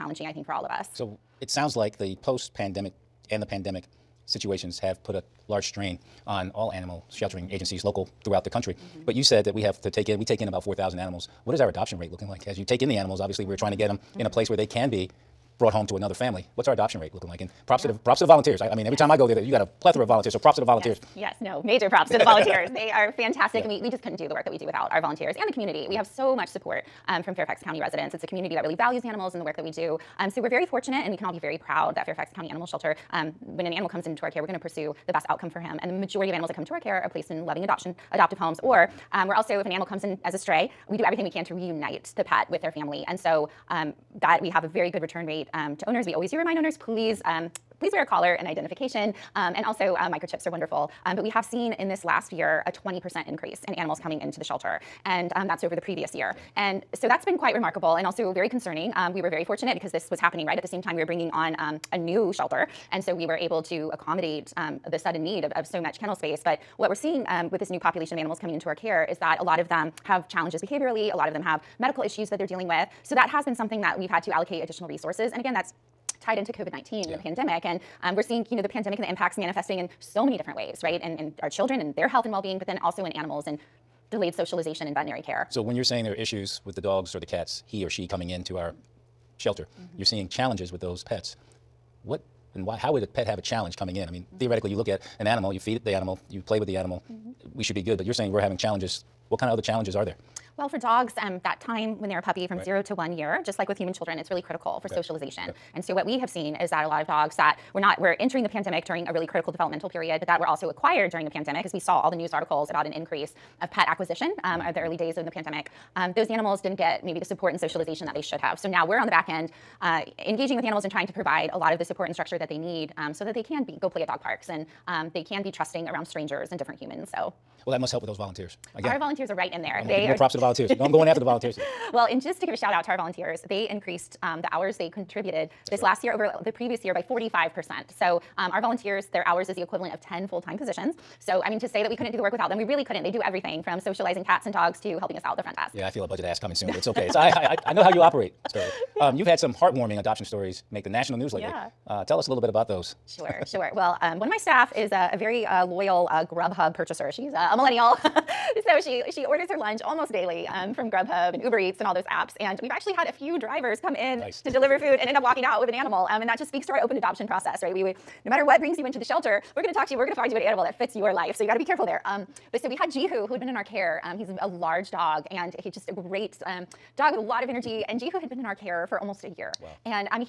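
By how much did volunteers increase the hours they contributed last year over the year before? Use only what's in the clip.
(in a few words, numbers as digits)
45%.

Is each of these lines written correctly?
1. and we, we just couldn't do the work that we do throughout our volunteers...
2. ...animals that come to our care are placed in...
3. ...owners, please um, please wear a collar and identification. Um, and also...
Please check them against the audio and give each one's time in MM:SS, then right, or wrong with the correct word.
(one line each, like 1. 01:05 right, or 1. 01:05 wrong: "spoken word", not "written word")
1. 00:23 wrong: "without", not "throughout"
2. 00:36 right
3. 00:46 right.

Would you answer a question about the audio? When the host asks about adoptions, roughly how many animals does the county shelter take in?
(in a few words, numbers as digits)
4,000.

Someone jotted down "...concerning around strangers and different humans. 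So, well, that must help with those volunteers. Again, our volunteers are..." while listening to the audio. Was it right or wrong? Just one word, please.
wrong.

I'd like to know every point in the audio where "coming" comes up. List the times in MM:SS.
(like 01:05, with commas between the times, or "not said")
00:54, 01:08, 01:28, 01:33, 02:26.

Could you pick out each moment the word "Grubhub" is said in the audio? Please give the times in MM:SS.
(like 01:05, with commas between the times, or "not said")
02:36, 02:40.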